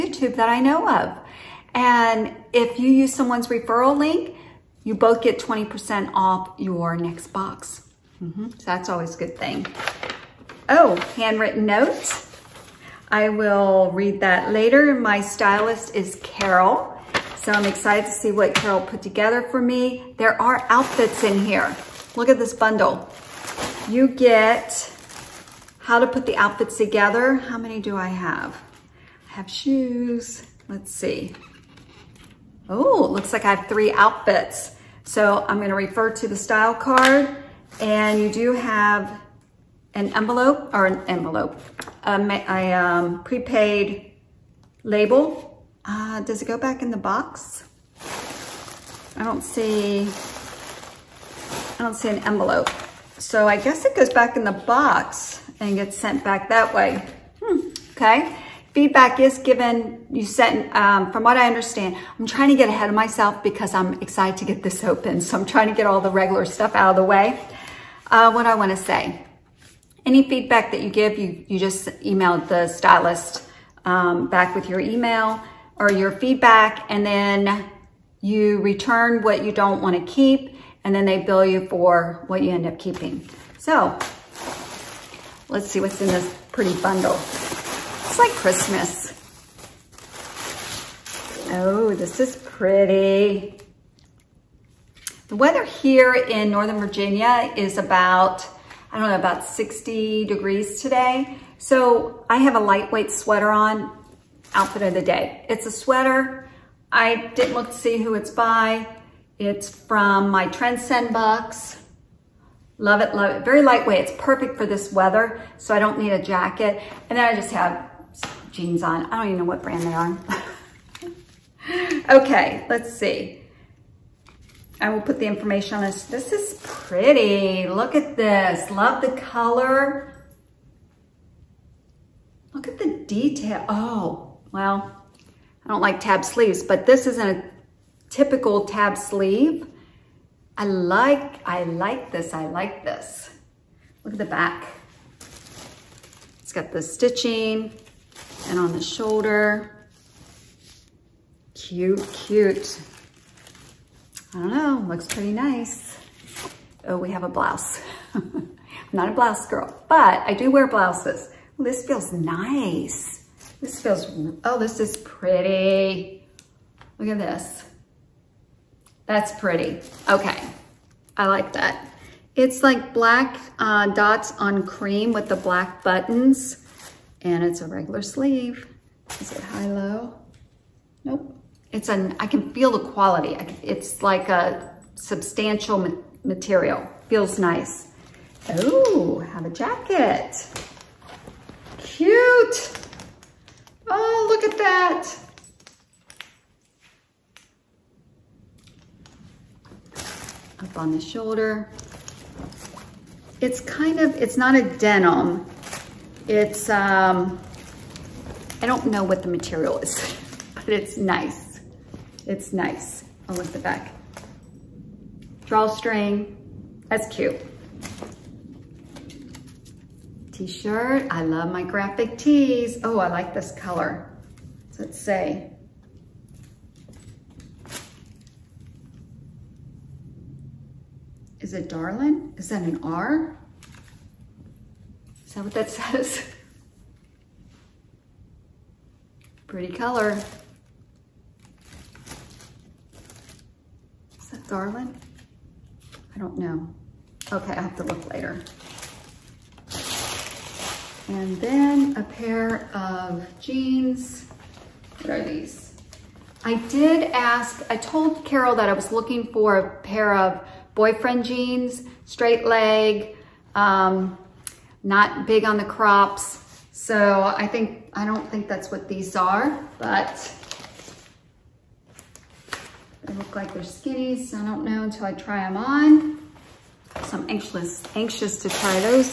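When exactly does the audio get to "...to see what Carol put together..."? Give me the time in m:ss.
0:18.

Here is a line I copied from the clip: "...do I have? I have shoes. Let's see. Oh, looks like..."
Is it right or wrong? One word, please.
right.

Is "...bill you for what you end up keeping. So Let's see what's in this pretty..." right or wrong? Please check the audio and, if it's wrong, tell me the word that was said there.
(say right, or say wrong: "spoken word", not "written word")
right.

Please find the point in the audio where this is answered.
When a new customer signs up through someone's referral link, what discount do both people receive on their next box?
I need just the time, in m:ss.
0:05.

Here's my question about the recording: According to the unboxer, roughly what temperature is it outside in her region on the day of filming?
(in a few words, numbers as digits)
60 degrees.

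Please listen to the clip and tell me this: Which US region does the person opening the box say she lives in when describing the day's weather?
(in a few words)
Northern Virginia.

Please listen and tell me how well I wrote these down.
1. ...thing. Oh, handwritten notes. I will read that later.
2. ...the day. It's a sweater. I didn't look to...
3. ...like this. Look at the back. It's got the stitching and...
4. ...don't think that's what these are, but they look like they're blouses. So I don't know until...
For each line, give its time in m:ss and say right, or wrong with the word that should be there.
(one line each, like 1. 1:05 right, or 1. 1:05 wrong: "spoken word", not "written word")
1. 0:09 right
2. 1:44 right
3. 2:22 right
4. 4:28 wrong: "skinnies", not "blouses".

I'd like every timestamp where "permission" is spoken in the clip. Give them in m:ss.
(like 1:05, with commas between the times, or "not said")
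not said.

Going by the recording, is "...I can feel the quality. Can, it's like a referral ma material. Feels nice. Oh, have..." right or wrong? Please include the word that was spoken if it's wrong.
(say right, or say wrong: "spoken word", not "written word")
wrong: "substantial", not "referral".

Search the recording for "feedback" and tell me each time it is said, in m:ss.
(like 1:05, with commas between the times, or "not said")
0:58, 1:10, 1:16.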